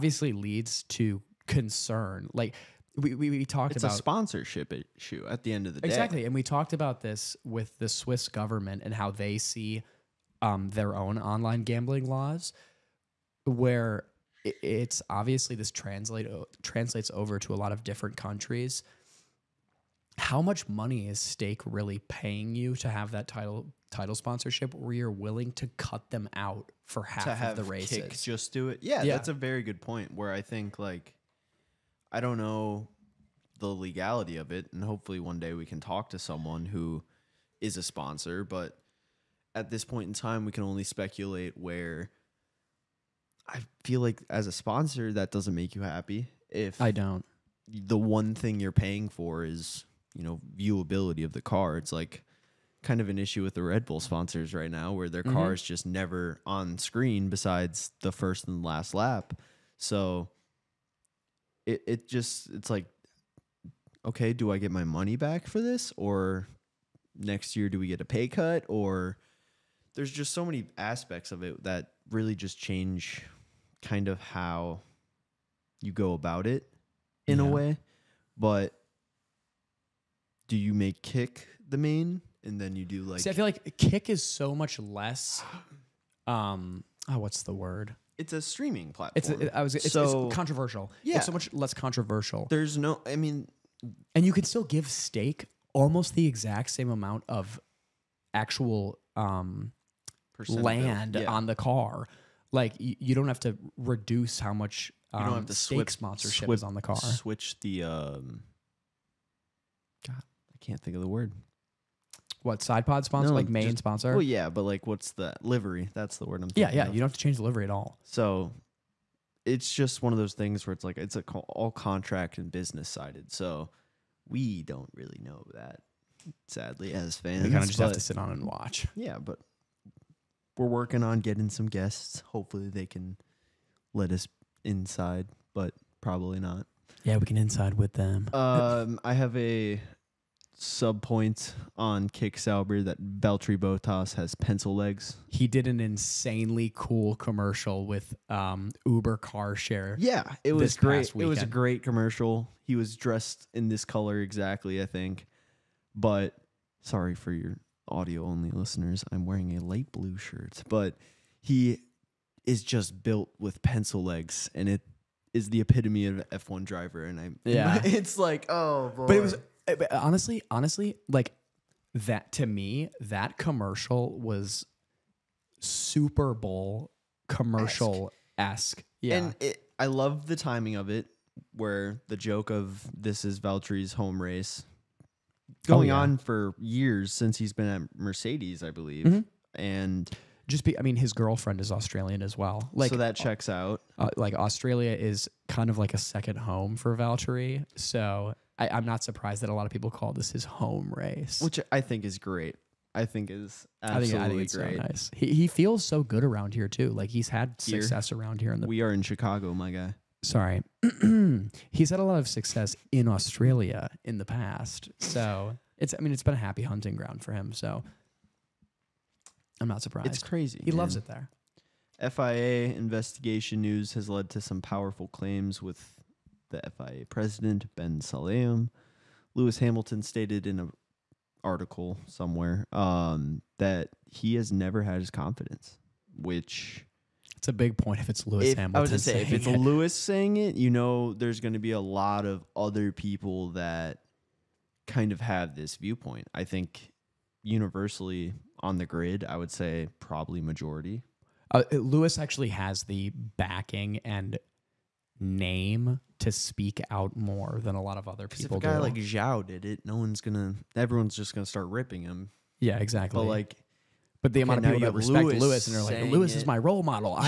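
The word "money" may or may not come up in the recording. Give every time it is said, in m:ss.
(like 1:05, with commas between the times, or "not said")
0:20, 1:04.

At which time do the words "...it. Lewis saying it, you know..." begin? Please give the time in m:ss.
3:59.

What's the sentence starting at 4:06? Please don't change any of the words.
I think universally on the grid, I would say probably majority.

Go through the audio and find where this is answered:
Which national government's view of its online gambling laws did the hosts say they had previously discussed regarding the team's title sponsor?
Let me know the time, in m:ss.
0:07.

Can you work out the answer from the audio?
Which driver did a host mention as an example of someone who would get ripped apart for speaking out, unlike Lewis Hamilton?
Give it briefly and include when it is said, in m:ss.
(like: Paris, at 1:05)
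Zhou, at 4:18.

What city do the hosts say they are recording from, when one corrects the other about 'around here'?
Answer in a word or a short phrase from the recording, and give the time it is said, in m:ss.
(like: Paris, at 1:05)
Chicago, at 3:29.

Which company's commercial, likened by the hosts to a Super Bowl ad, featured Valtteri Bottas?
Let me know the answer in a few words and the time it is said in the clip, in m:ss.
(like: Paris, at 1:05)
Uber car share, at 2:28.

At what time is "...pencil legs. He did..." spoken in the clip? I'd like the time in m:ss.
2:24.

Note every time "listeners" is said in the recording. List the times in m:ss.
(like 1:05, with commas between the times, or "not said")
2:38.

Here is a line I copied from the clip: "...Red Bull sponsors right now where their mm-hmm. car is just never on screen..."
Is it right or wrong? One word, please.
right.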